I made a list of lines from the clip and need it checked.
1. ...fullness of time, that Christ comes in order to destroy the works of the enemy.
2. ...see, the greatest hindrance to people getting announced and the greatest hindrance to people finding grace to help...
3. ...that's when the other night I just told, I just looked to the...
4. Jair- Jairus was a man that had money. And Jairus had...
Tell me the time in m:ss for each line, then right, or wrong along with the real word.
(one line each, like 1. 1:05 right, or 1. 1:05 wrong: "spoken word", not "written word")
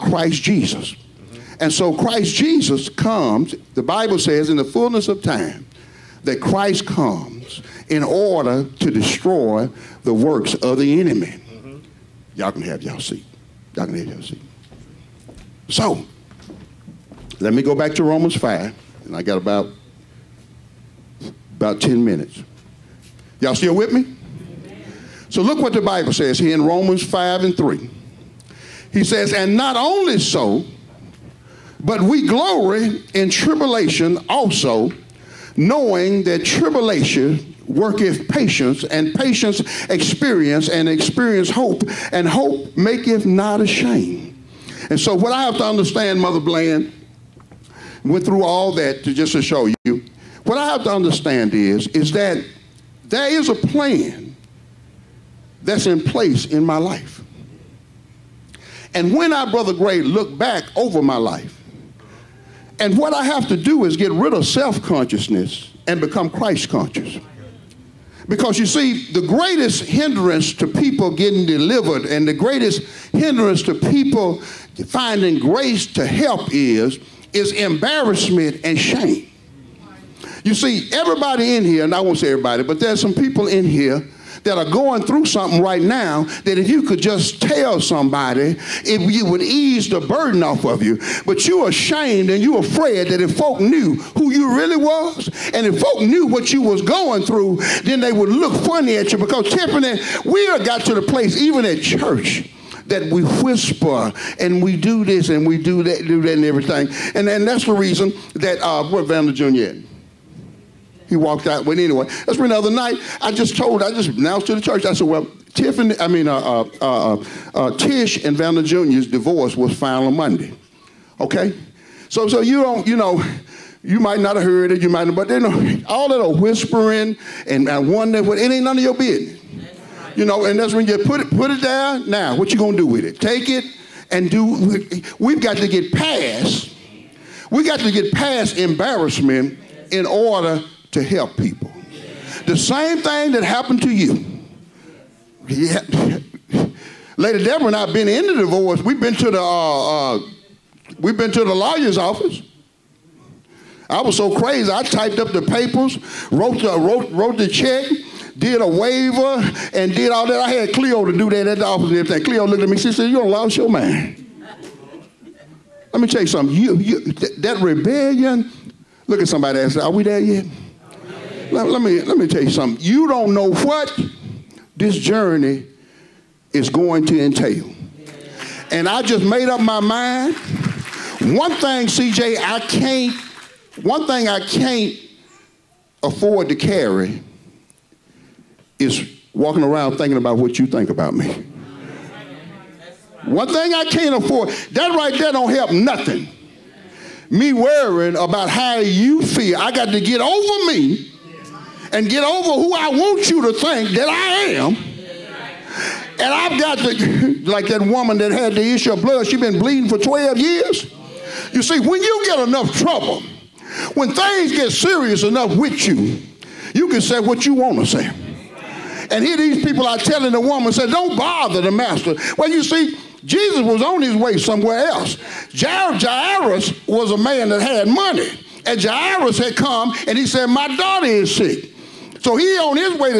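1. 0:04 right
2. 1:08 wrong: "delivered", not "announced"
3. 1:52 wrong: "announced", not "looked"
4. 3:45 right.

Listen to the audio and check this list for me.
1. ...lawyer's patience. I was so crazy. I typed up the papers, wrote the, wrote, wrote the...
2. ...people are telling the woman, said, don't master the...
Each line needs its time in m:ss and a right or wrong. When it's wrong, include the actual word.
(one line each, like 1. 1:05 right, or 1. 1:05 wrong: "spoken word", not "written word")
1. 2:31 wrong: "office", not "patience"
2. 3:39 wrong: "bother", not "master".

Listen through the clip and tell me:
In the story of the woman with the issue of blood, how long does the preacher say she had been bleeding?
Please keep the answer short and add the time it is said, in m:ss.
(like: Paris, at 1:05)
12 years, at 3:29.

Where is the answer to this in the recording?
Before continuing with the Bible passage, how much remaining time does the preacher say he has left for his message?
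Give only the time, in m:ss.
0:21.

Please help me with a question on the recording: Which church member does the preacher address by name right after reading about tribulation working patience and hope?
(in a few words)
Mother Bland.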